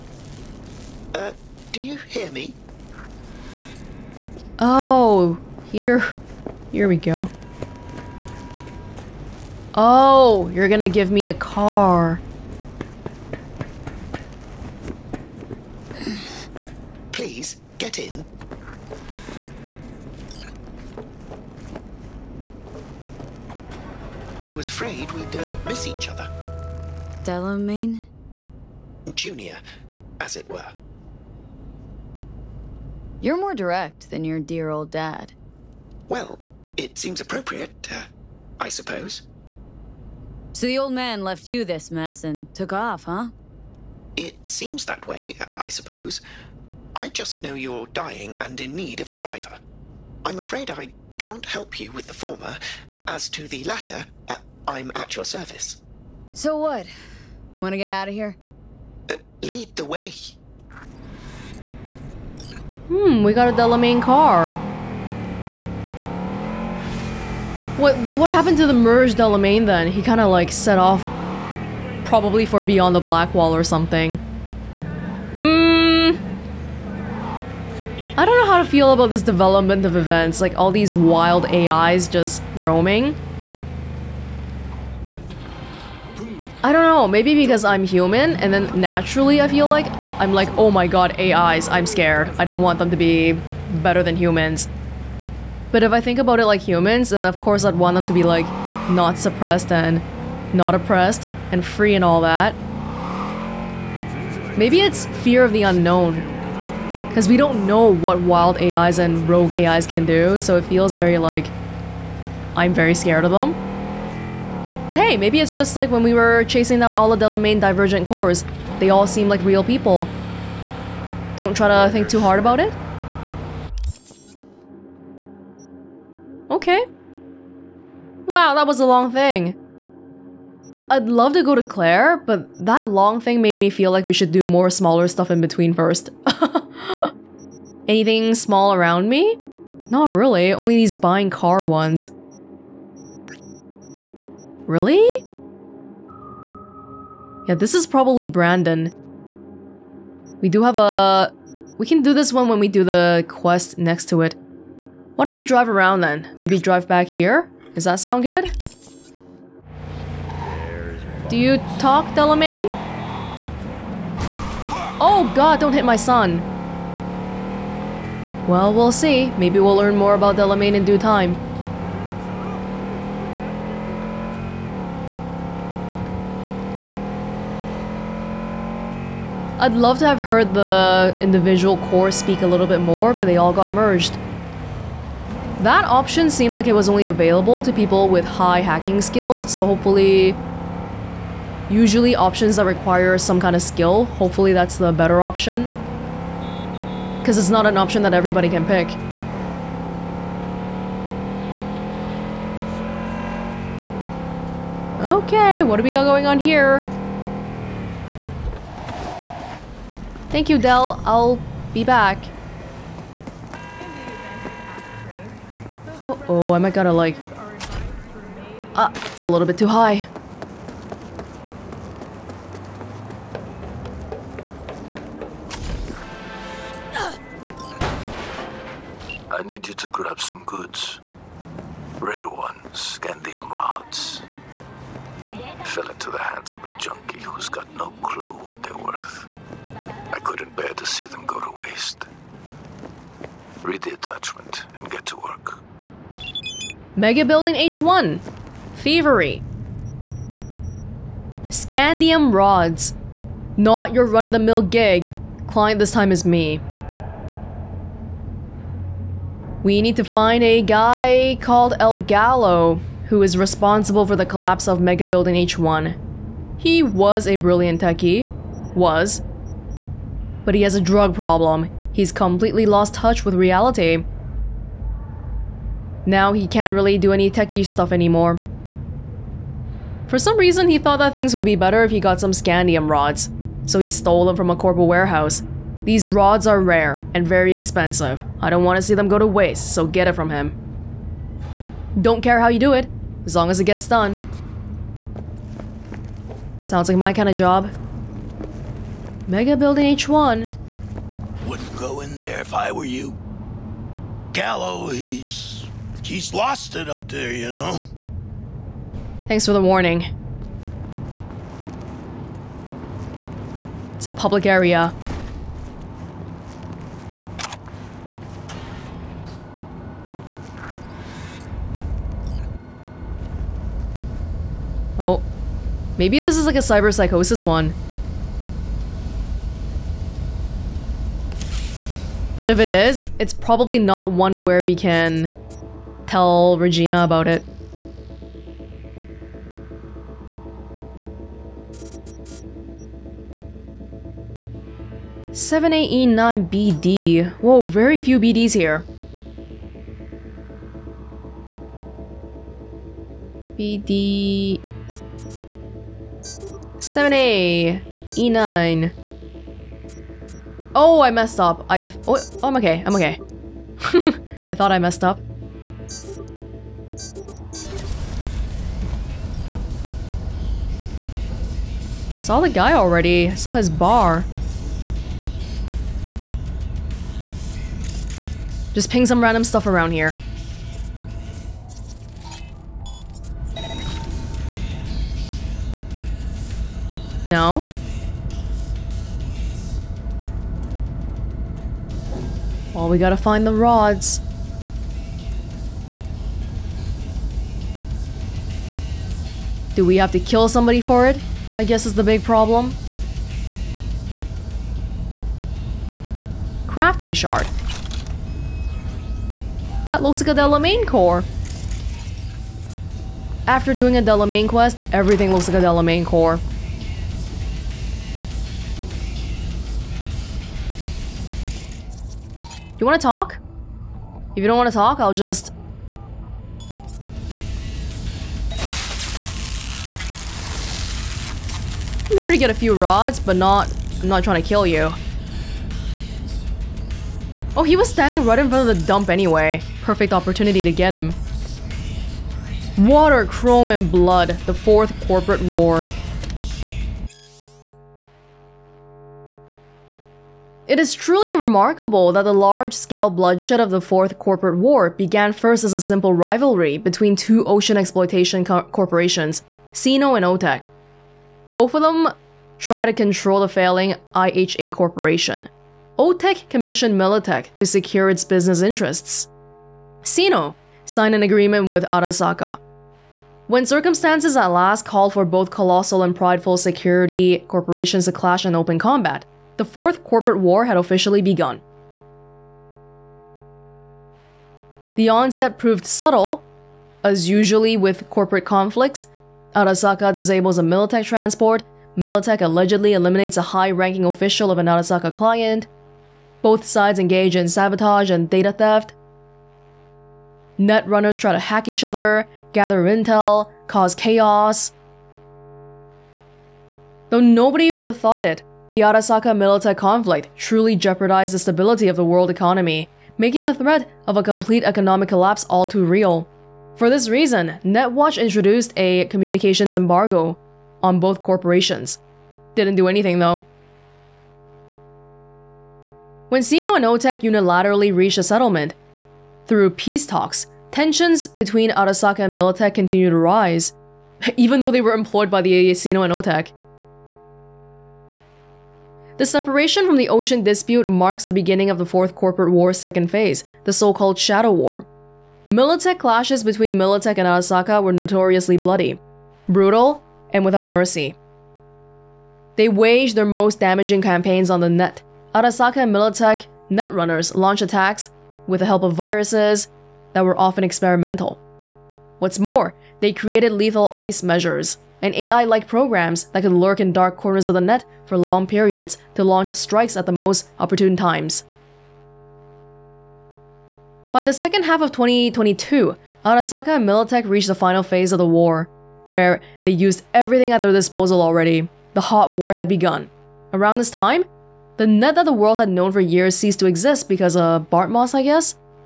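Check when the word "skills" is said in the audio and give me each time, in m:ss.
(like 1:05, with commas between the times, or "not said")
3:08, 3:13.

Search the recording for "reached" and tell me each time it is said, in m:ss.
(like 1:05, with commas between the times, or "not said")
8:47, 9:37.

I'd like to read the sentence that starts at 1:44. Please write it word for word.
Maybe it's fear of the unknown.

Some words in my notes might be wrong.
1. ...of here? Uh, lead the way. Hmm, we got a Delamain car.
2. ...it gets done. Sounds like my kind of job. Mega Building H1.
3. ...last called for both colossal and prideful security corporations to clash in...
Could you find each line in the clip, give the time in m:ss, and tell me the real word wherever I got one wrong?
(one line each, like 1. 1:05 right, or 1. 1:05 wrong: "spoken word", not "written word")
1. 0:58 right
2. 4:53 right
3. 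7:54 right.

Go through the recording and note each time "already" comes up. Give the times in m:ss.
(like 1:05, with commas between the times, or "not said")
6:12, 9:41.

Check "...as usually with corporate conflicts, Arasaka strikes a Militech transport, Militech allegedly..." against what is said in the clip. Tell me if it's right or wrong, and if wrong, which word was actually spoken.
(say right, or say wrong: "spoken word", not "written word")
wrong: "disables", not "strikes".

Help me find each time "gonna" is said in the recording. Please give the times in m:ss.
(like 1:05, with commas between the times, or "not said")
0:10, 3:36.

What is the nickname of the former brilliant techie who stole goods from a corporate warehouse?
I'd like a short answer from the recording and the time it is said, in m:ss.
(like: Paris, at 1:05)
El Gallo, at 4:21.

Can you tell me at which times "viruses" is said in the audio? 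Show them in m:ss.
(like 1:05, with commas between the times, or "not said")
9:18.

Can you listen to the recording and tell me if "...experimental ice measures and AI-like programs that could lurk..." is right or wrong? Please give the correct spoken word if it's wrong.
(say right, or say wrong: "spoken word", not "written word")
wrong: "lethal", not "experimental".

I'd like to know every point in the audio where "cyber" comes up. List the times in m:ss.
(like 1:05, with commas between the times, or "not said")
5:26.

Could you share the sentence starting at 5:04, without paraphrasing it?
Gallo, he's He's lost it up there, you know?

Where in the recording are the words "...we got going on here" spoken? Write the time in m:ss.
3:25.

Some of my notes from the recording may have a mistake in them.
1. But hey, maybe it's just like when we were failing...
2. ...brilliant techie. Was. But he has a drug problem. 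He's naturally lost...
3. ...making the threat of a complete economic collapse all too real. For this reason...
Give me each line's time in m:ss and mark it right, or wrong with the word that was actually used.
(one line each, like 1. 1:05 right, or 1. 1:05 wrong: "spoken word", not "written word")
1. 1:54 wrong: "chasing", not "failing"
2. 4:27 wrong: "completely", not "naturally"
3. 8:33 right.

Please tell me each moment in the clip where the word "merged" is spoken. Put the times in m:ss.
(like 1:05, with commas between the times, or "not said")
1:08, 3:03.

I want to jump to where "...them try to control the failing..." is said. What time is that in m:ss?
7:41.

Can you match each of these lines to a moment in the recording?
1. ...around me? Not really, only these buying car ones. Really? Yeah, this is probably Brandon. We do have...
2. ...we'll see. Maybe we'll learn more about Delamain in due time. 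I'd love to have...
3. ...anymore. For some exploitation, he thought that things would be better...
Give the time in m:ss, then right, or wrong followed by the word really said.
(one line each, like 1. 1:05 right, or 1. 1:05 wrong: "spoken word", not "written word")
1. 2:18 right
2. 2:48 right
3. 4:37 wrong: "reason", not "exploitation".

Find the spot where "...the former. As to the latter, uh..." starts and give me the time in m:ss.
0:52.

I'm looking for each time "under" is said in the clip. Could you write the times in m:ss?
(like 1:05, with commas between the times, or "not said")
not said.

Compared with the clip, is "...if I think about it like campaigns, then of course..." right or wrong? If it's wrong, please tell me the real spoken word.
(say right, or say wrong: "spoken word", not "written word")
wrong: "humans", not "campaigns".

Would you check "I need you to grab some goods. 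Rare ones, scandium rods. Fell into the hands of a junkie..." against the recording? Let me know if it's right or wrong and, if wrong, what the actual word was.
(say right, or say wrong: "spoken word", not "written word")
right.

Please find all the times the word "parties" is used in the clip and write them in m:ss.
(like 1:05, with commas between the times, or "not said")
not said.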